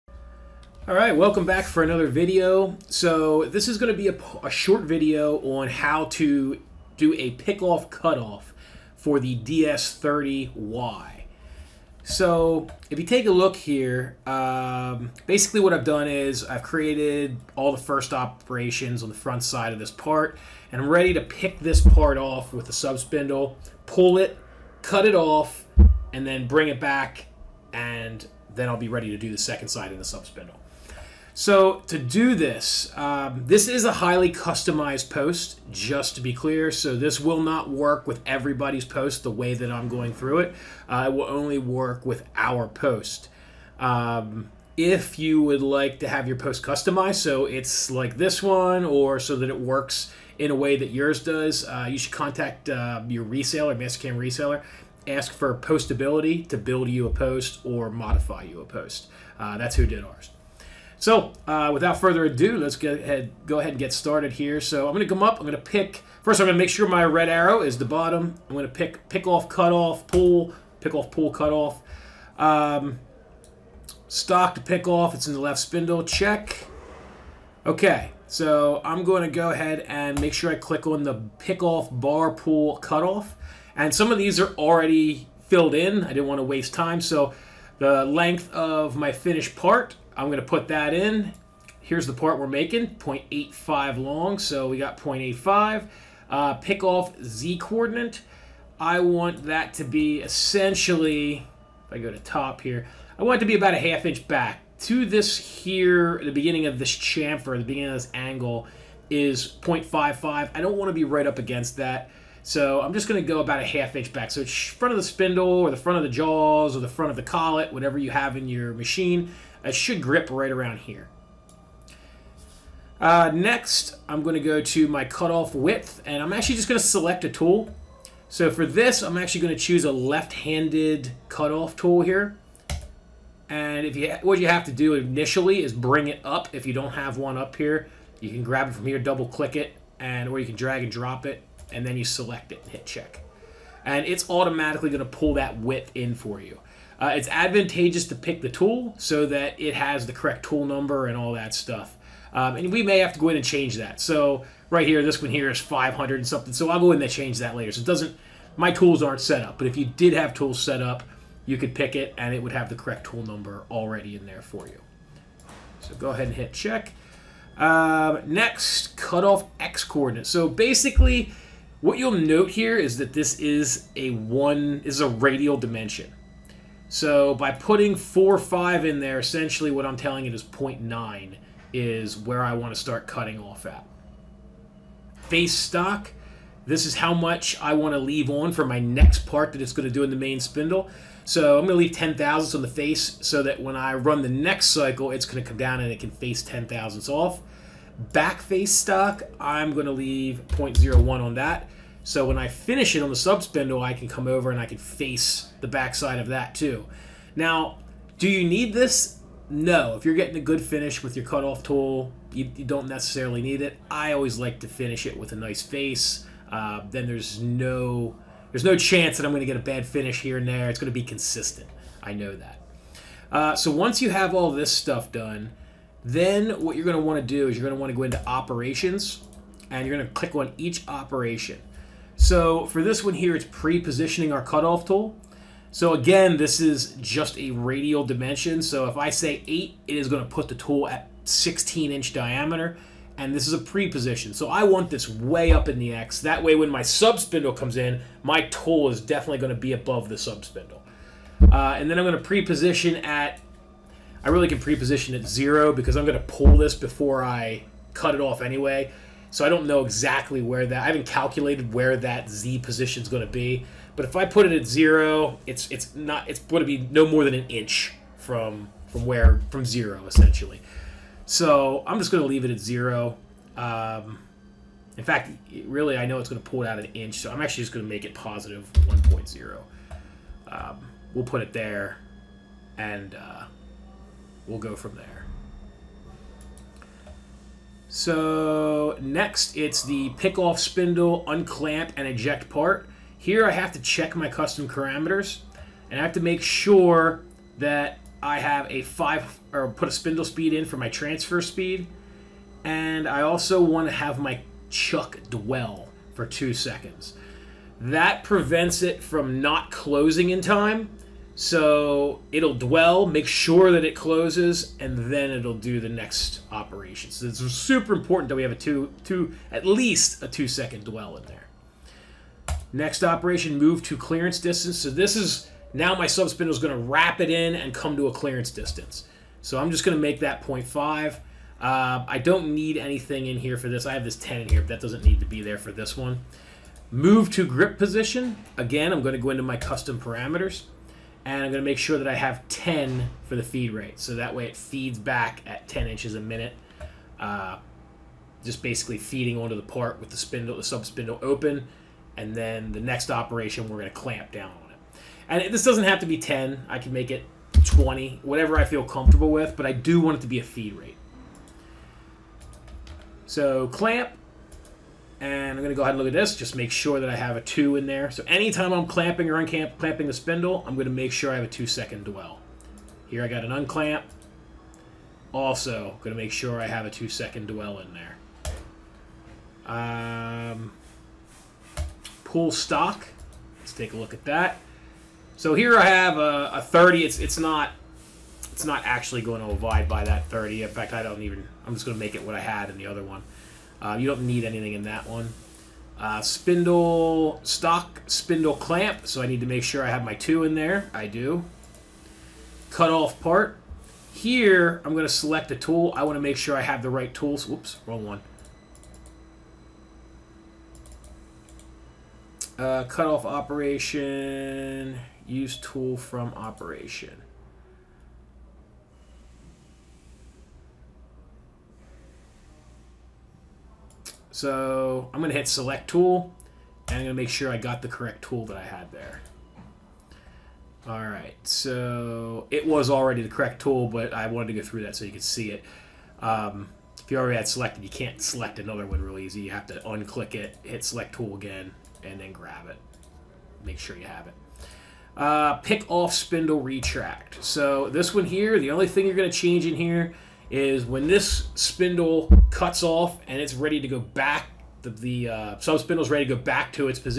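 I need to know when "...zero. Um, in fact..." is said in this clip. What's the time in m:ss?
4:32.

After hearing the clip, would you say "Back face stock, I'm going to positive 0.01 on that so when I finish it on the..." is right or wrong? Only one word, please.
wrong.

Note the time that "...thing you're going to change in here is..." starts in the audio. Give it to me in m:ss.
7:28.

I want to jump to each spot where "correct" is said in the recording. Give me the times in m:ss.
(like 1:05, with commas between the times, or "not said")
2:30, 2:42, 7:07, 7:13.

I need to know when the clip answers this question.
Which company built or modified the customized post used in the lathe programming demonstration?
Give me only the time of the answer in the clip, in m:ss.
0:55.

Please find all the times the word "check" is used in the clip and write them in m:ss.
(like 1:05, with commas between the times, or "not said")
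1:16, 2:22, 2:46, 4:53.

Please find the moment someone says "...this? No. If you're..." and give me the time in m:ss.
3:28.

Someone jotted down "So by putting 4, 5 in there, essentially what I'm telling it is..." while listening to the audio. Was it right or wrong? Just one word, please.
right.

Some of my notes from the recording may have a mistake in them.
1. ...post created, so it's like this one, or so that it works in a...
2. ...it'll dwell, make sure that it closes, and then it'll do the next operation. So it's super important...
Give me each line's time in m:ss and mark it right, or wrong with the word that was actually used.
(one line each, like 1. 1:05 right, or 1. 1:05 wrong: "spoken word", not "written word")
1. 0:46 wrong: "customized", not "created"
2. 5:12 right.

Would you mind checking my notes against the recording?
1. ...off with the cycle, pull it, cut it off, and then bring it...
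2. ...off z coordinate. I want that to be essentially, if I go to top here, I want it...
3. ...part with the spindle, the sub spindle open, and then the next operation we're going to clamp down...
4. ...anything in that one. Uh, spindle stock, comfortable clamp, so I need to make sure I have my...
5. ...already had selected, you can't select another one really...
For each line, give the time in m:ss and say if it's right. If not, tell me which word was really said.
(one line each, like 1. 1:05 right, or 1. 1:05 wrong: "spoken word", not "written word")
1. 0:22 wrong: "subspindle", not "cycle"
2. 1:36 right
3. 5:49 right
4. 6:34 wrong: "spindle", not "comfortable"
5. 7:17 right.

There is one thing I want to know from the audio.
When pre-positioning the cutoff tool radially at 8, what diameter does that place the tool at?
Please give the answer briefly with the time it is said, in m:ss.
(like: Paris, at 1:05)
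16 inch, at 4:01.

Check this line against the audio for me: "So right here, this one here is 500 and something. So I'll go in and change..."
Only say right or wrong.
right.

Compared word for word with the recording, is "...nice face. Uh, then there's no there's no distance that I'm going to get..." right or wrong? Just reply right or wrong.
wrong.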